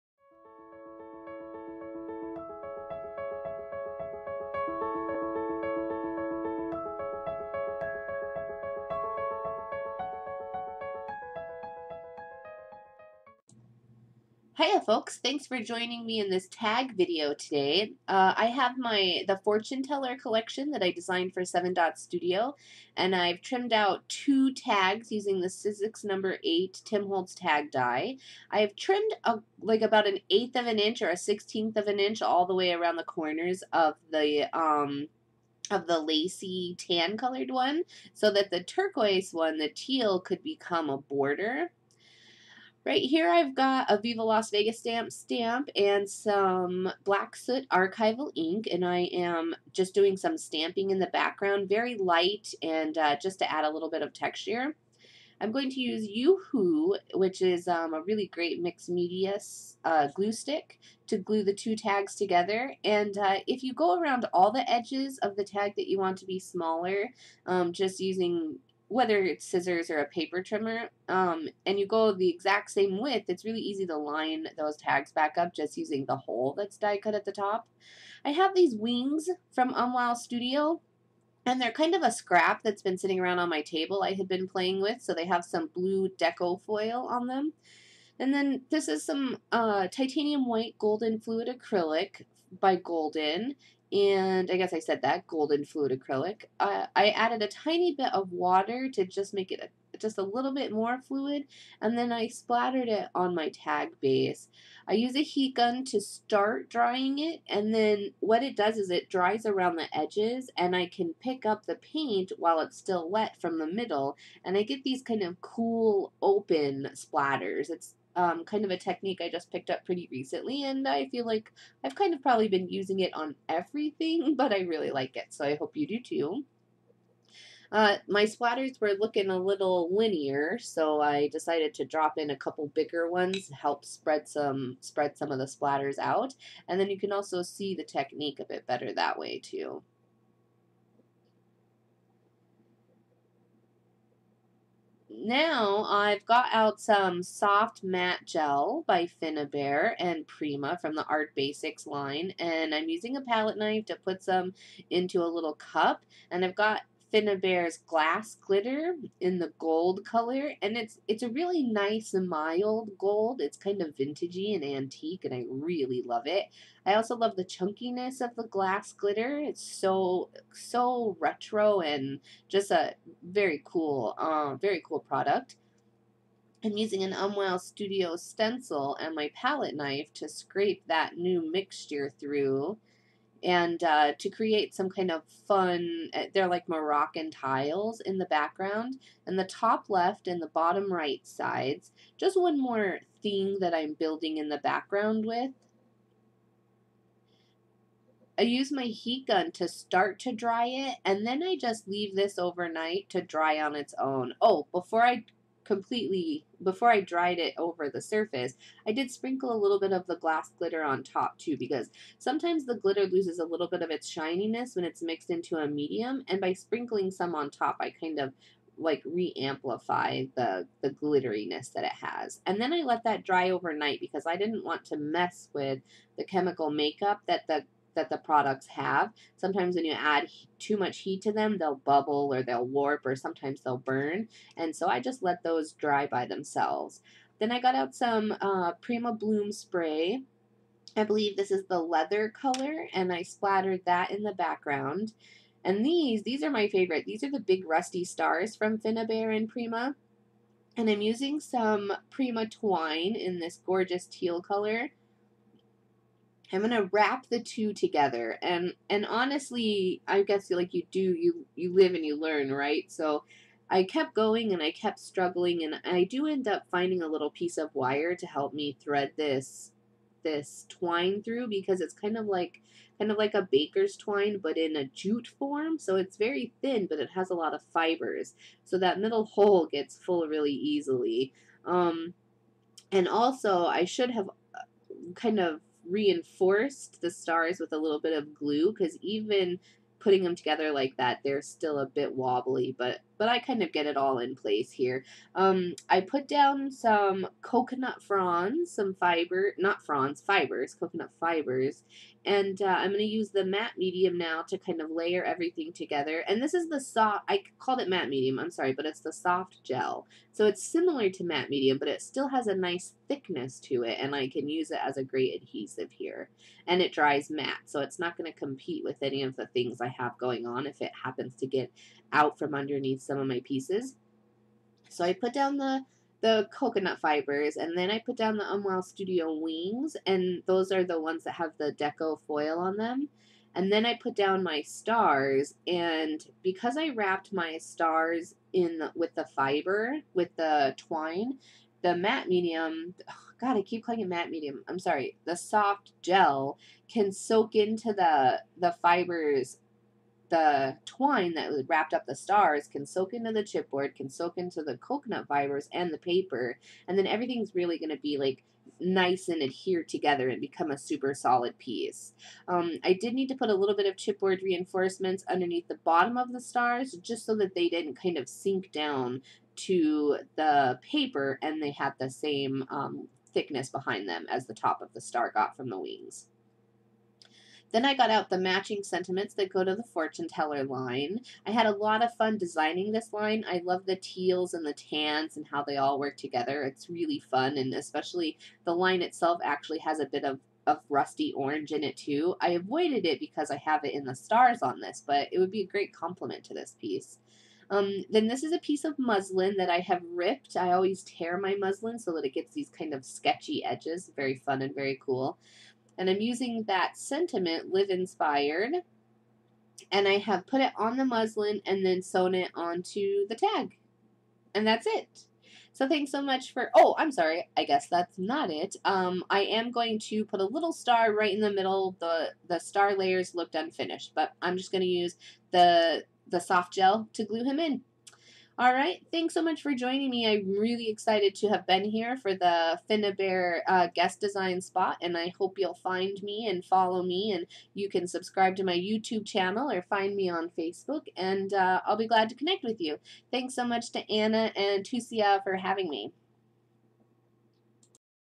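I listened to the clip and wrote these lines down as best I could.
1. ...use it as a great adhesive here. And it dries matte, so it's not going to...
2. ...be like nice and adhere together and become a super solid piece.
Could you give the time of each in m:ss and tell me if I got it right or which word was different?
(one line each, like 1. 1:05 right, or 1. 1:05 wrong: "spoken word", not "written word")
1. 5:14 right
2. 5:58 right.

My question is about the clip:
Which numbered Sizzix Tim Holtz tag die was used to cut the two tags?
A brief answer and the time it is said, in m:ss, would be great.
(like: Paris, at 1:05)
8, at 0:26.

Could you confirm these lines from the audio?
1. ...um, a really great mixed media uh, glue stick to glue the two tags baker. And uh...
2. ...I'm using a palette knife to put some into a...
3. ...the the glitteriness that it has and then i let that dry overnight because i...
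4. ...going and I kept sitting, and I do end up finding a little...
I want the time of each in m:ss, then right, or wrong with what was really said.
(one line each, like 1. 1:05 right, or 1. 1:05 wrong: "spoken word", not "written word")
1. 0:57 wrong: "together", not "baker"
2. 2:32 right
3. 3:40 right
4. 4:24 wrong: "struggling", not "sitting".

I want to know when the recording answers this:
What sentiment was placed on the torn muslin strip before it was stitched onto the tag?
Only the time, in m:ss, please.
6:47.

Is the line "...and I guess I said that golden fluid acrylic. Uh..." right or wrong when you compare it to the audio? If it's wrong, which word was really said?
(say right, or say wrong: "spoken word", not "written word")
right.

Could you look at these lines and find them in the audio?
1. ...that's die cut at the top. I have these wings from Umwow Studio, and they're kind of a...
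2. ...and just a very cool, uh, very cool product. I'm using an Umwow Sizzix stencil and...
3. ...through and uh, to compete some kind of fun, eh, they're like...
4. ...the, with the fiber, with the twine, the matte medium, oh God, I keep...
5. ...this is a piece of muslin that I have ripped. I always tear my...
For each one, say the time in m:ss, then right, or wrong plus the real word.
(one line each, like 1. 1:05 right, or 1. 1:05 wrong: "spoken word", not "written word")
1. 1:16 right
2. 2:51 wrong: "Studio", not "Sizzix"
3. 3:02 wrong: "create", not "compete"
4. 5:38 right
5. 6:38 right.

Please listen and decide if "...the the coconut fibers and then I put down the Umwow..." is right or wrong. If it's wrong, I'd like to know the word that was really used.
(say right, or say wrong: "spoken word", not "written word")
right.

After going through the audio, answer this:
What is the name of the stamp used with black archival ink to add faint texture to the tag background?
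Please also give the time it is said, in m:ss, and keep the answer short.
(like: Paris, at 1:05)
Viva Las Vegas, at 0:44.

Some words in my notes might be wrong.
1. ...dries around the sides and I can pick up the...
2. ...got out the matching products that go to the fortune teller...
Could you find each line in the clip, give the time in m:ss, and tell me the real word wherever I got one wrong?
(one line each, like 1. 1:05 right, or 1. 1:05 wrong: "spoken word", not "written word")
1. 1:49 wrong: "edges", not "sides"
2. 6:17 wrong: "sentiments", not "products".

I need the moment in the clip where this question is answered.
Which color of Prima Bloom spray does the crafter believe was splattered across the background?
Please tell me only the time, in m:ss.
4:01.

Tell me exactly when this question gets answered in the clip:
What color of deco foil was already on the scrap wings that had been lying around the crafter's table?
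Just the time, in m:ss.
1:25.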